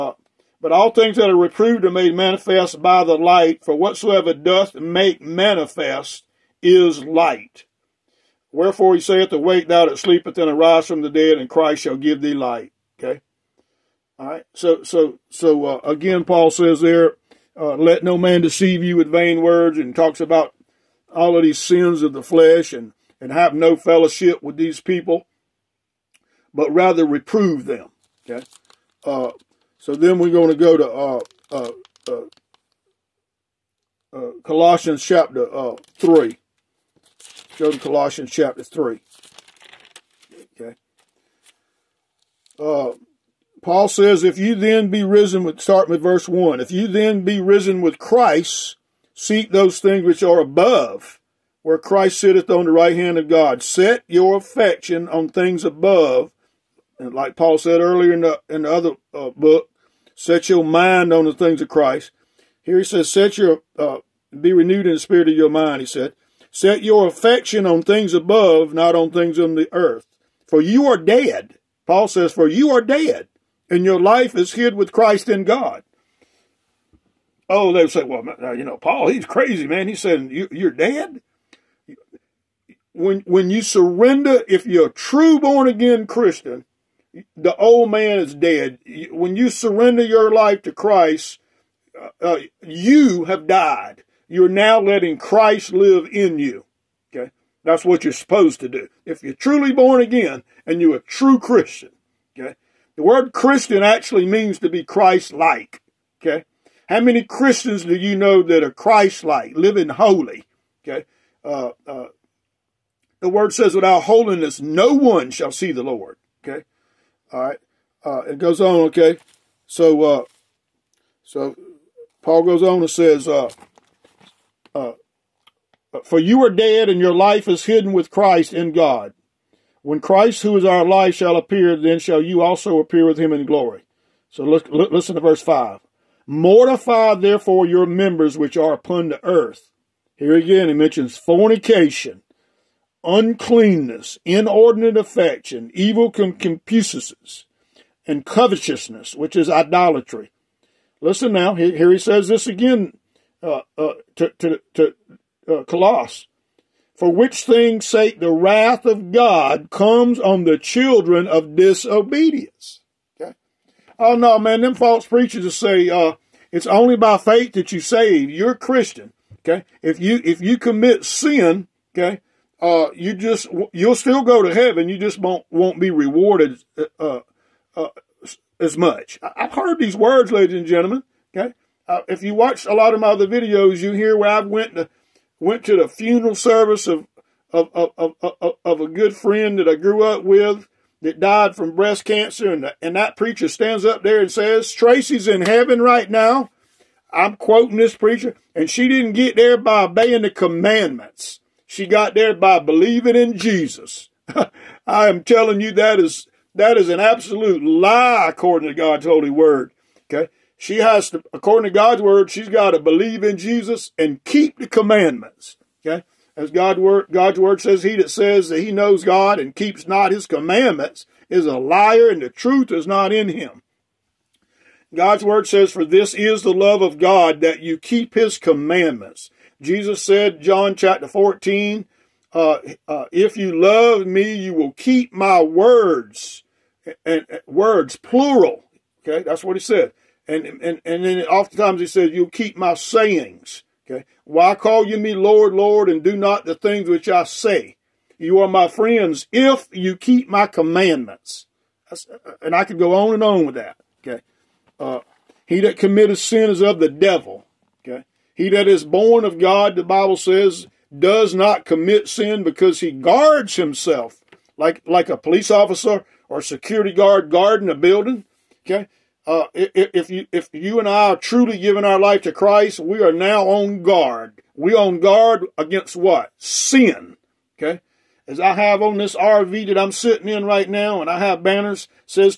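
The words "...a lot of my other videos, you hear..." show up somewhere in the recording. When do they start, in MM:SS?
03:02.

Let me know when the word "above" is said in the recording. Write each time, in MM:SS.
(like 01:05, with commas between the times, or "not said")
00:50, 00:55, 01:08.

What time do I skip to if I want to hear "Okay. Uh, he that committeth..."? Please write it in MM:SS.
04:14.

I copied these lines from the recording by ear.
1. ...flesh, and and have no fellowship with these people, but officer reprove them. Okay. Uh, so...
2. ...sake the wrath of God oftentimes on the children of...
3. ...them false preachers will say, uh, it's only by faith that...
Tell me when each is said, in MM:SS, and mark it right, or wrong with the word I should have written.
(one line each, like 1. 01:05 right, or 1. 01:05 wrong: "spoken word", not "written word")
1. 00:22 wrong: "rather", not "officer"
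2. 02:37 wrong: "comes", not "oftentimes"
3. 02:44 right.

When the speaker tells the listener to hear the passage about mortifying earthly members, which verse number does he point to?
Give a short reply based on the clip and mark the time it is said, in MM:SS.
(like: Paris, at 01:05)
verse 5, at 02:15.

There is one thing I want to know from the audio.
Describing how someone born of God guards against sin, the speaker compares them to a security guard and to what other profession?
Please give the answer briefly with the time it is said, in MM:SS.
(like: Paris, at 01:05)
police officer, at 04:25.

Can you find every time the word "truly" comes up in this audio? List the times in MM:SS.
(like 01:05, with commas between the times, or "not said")
01:39, 04:31.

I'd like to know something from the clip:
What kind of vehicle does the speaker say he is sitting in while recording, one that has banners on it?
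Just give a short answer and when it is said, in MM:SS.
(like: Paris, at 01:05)
RV, at 04:39.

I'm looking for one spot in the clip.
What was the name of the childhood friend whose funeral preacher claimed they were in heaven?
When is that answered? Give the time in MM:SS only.
03:14.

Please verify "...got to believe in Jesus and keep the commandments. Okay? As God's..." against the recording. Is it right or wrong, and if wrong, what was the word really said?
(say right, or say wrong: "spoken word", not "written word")
right.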